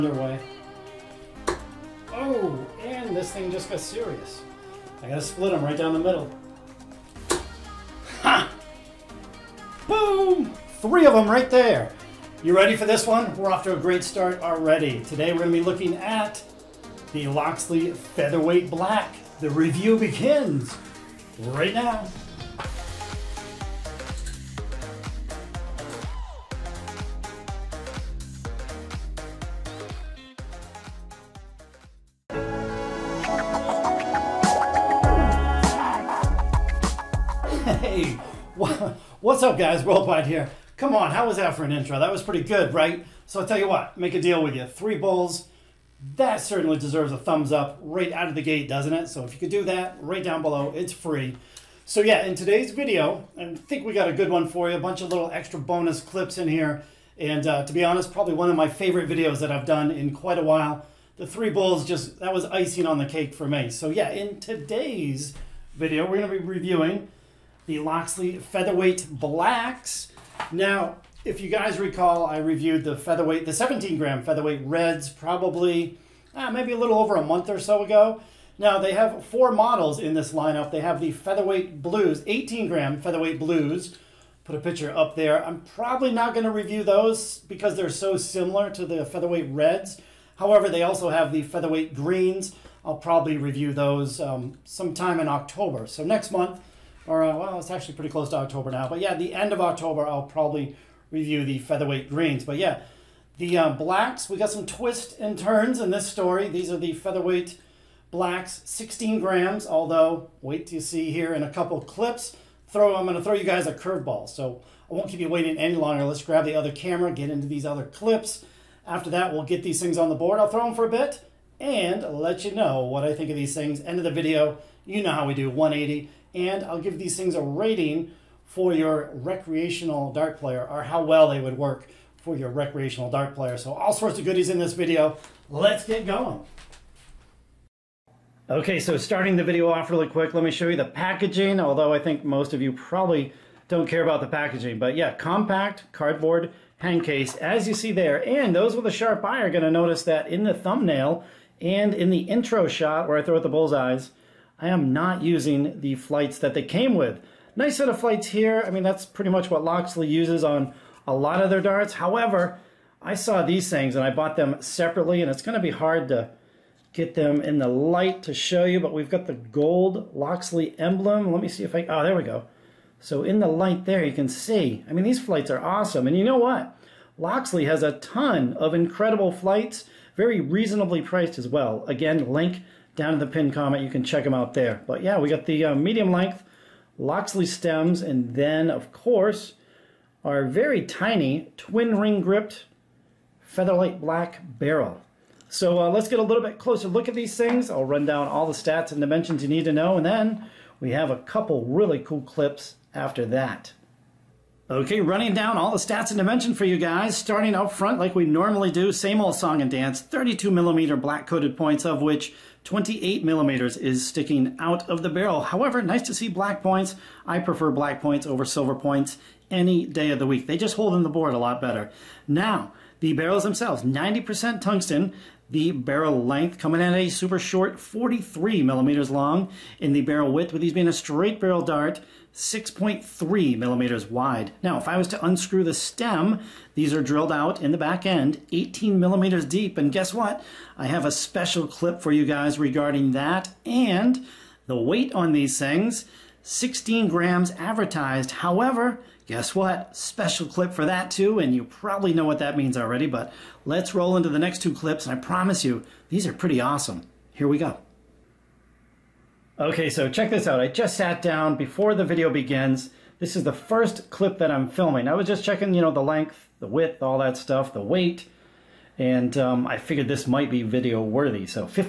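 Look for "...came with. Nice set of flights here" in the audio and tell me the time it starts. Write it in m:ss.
2:36.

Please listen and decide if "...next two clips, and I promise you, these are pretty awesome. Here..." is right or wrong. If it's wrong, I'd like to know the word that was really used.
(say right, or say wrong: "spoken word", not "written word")
right.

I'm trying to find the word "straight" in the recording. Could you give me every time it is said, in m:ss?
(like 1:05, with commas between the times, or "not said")
3:50.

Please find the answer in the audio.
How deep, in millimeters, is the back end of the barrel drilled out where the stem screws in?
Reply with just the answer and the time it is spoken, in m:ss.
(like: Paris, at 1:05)
18 millimeters, at 3:58.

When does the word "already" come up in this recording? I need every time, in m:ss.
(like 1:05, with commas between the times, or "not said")
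0:14, 4:12.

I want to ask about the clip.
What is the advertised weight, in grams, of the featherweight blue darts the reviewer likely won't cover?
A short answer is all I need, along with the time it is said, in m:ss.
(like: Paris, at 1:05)
18 grams, at 1:22.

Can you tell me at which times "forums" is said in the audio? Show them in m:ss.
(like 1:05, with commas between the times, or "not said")
not said.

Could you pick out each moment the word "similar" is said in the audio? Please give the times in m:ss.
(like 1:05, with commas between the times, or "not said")
1:28.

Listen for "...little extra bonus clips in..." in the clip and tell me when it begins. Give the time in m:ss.
0:55.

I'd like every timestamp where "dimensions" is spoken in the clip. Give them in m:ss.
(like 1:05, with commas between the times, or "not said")
3:19, 3:26.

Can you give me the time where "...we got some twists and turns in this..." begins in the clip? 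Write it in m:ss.
1:44.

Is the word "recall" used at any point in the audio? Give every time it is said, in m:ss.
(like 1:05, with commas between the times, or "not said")
1:11.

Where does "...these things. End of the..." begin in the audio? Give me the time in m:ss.
2:03.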